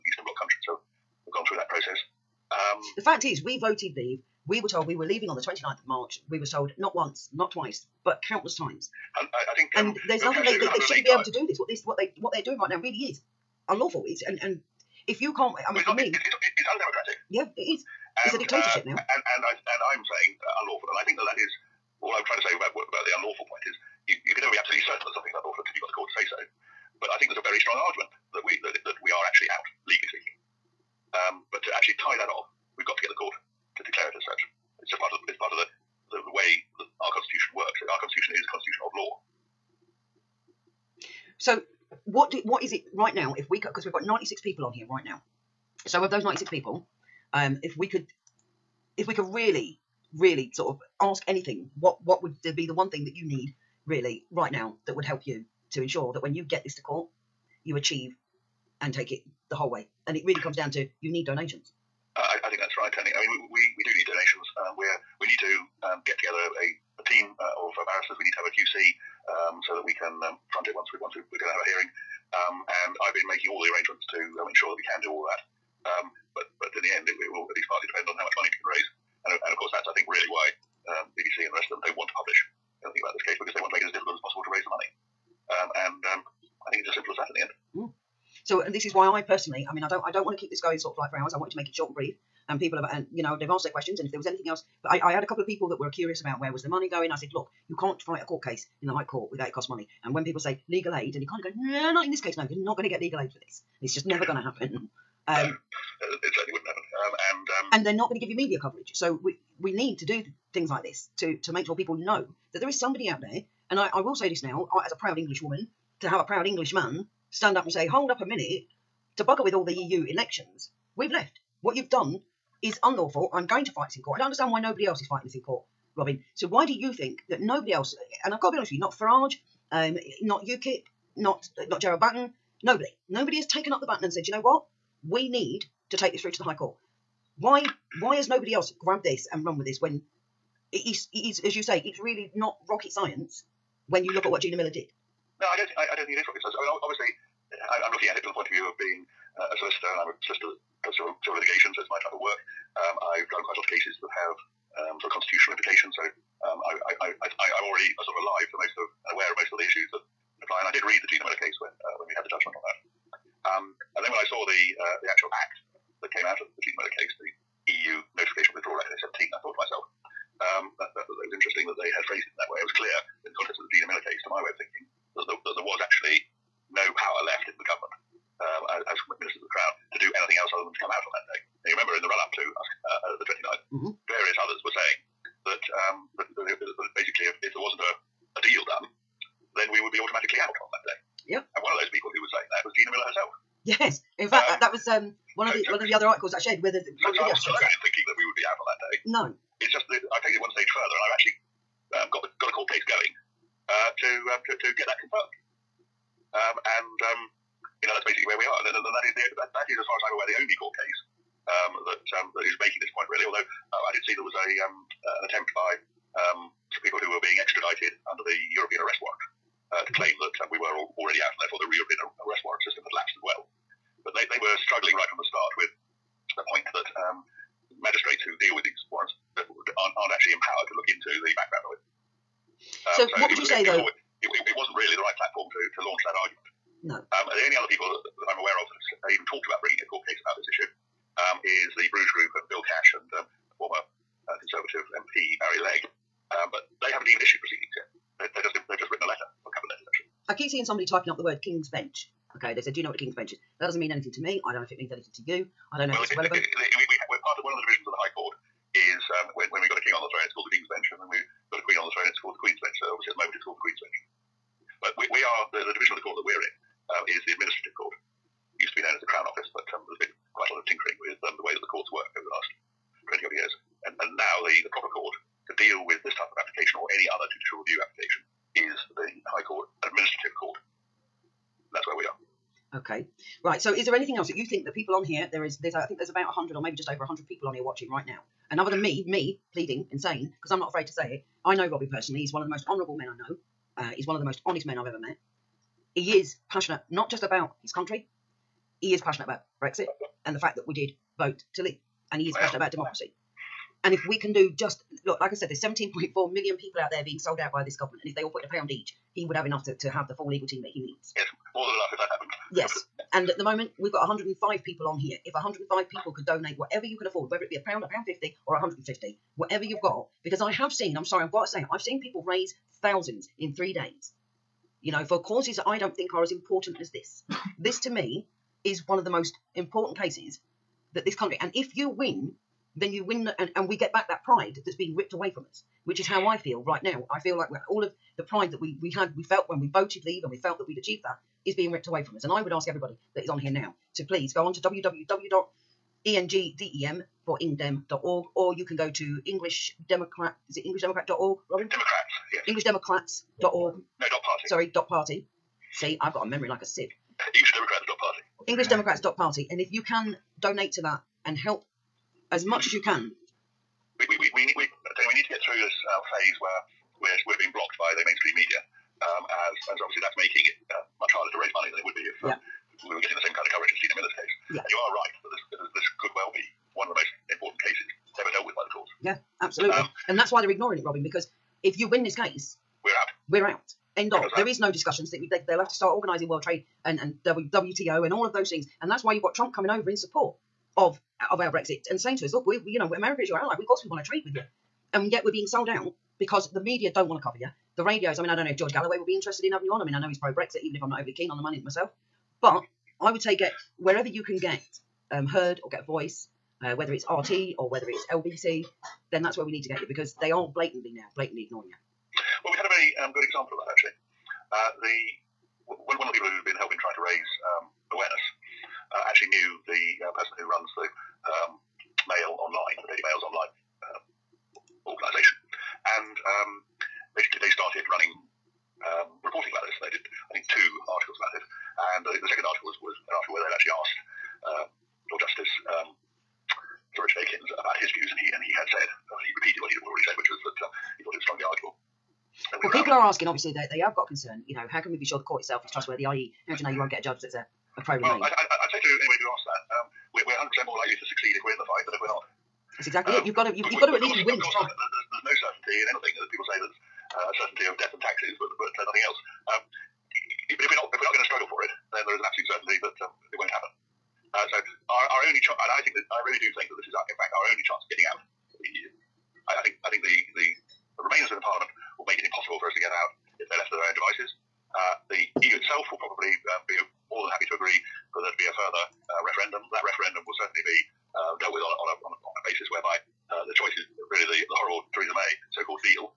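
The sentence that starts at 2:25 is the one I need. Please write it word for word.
No, I don't think I, I don't think it is rocket science.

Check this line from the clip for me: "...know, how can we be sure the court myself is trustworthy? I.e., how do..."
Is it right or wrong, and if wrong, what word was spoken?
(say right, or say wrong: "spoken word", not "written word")
wrong: "itself", not "myself".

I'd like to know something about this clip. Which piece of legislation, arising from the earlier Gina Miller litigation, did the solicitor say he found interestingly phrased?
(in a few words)
EU notification of withdrawal Act 2017.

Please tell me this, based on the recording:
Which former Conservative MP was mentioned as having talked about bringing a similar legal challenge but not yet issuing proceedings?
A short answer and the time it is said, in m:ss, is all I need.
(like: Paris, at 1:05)
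Barry Legg, at 4:05.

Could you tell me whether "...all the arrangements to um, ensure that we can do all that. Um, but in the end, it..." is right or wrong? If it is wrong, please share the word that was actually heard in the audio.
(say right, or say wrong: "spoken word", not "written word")
right.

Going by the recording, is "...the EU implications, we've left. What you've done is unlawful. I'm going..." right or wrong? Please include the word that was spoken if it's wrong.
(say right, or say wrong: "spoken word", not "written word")
wrong: "elections", not "implications".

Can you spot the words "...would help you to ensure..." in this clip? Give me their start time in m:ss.
0:54.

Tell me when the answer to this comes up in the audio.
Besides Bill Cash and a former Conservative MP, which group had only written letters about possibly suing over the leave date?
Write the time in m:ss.
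4:01.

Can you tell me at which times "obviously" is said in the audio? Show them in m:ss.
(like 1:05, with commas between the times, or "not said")
2:26, 4:22, 6:09, 7:23.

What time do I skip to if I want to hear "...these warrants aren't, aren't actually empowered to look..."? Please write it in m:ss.
3:48.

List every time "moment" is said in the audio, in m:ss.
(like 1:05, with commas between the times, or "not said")
4:23, 5:13.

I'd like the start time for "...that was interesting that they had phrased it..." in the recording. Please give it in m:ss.
2:51.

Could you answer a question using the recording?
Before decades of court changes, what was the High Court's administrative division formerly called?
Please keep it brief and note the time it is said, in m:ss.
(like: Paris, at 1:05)
Crown Office, at 4:29.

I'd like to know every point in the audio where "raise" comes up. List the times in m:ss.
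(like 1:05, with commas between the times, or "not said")
1:18, 1:24, 5:22, 6:11, 6:57.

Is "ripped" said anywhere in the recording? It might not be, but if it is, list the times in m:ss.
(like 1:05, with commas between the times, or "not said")
5:34, 5:41.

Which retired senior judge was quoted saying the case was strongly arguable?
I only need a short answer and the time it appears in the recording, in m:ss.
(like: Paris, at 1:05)
Sir Richard Aikens, at 7:16.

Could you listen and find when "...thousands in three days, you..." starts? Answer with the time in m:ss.
5:22.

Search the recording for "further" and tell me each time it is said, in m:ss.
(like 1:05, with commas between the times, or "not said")
3:20, 7:58.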